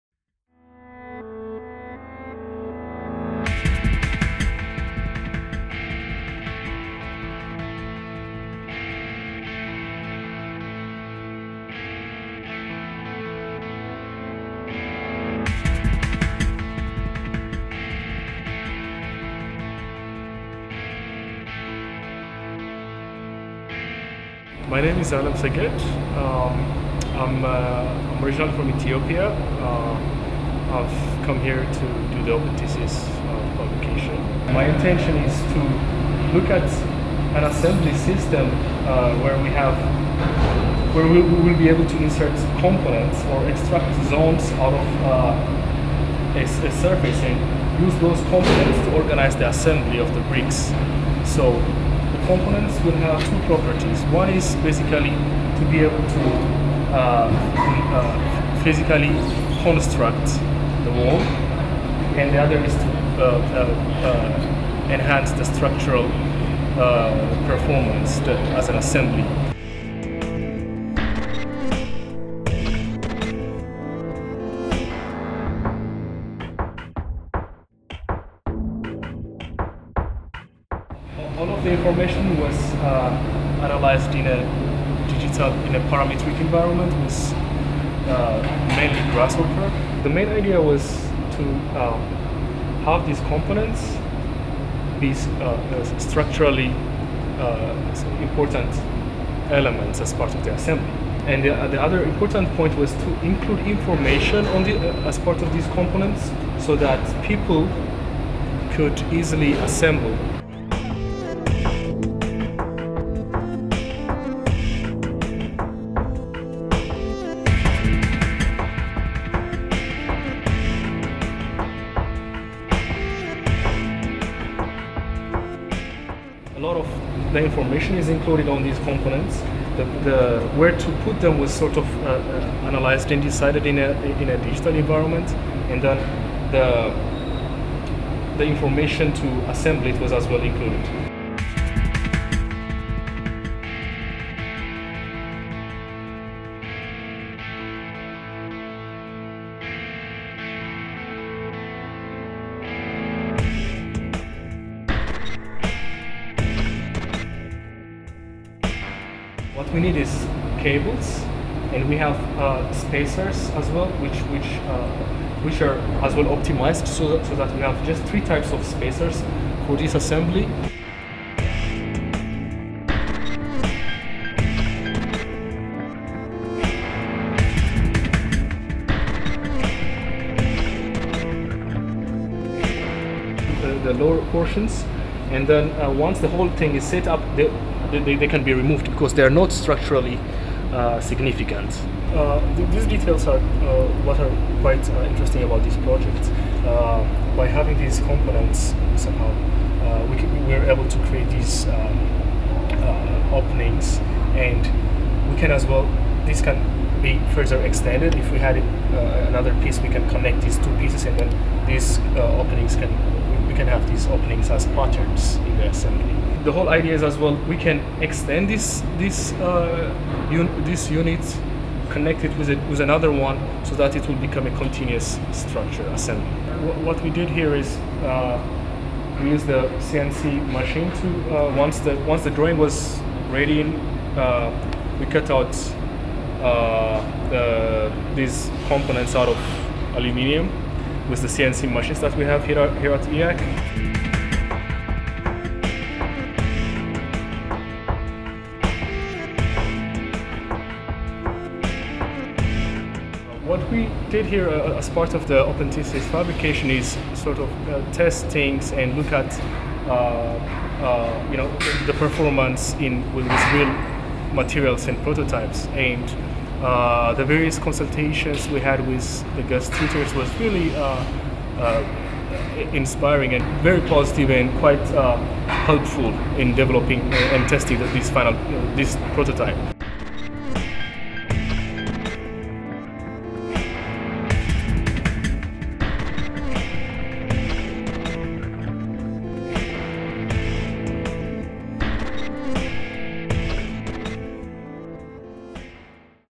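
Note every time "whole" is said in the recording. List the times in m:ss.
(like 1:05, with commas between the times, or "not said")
3:06, 3:36.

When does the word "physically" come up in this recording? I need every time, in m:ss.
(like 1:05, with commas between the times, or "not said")
0:58.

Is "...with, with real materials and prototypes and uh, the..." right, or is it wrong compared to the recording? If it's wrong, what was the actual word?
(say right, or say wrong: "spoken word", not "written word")
right.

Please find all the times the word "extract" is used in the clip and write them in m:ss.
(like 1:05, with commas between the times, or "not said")
0:43.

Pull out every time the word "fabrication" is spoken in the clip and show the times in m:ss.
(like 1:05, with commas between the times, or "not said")
0:33, 4:16.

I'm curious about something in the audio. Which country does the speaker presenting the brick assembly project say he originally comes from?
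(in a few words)
Ethiopia.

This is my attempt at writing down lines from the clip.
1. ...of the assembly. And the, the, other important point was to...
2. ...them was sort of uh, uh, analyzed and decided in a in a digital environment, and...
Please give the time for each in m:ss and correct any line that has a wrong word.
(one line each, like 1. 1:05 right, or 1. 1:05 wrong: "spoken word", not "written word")
1. 1:40 right
2. 2:11 right.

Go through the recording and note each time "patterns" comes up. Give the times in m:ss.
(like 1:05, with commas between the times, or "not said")
3:34.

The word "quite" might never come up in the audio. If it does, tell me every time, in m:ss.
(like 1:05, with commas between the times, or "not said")
3:14, 4:34.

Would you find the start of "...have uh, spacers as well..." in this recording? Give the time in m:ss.
2:41.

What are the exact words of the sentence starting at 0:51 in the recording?
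So the components will have two properties.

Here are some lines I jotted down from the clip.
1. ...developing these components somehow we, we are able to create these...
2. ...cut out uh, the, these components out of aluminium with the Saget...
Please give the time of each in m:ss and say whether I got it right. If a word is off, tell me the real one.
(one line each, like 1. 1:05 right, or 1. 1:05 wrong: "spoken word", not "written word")
1. 3:17 wrong: "having", not "developing"
2. 3:55 wrong: "CNC", not "Saget".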